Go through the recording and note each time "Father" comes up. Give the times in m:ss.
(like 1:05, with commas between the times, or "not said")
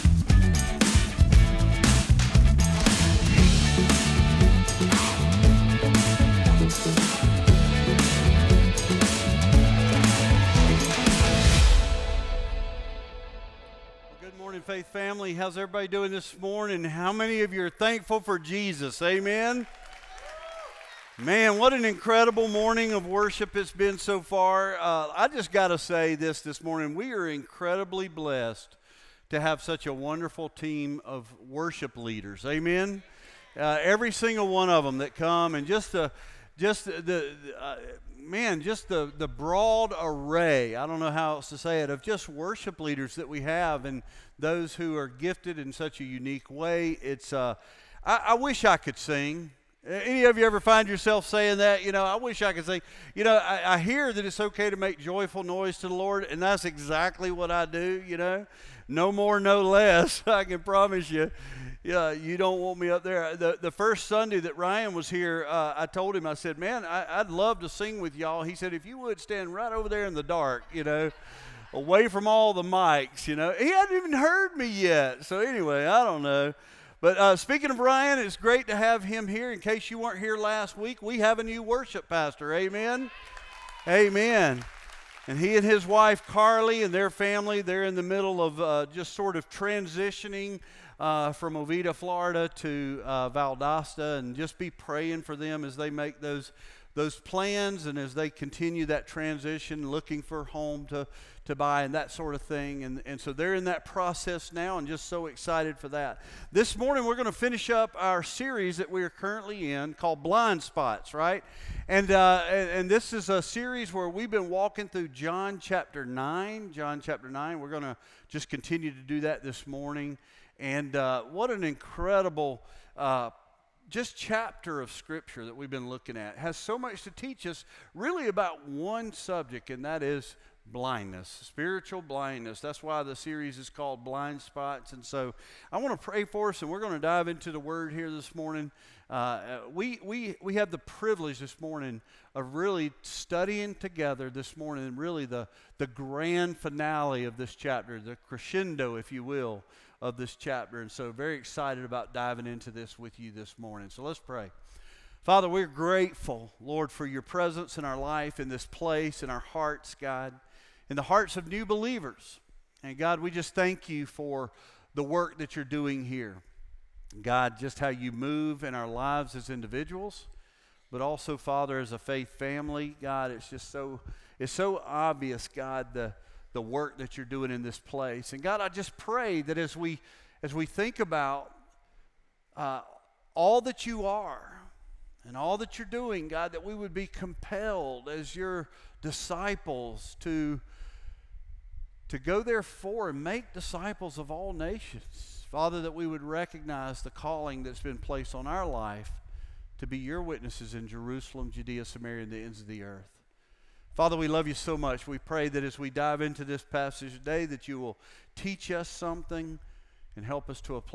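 2:35, 2:51, 3:15, 3:23.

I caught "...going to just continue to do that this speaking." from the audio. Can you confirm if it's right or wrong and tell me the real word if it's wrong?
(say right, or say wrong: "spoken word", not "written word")
wrong: "morning", not "speaking".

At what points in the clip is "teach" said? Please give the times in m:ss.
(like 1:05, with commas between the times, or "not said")
2:07, 3:28.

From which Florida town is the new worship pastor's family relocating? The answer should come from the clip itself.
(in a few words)
Oviedo.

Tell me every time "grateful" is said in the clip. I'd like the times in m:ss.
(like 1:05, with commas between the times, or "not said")
2:35.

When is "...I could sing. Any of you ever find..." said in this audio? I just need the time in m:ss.
0:48.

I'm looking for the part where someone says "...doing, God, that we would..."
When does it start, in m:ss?
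3:05.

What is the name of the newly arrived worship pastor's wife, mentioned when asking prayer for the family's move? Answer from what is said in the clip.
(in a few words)
Carly.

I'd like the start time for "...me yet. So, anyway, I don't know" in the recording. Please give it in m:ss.
1:14.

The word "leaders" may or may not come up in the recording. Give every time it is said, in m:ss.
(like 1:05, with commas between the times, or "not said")
0:31, 0:42.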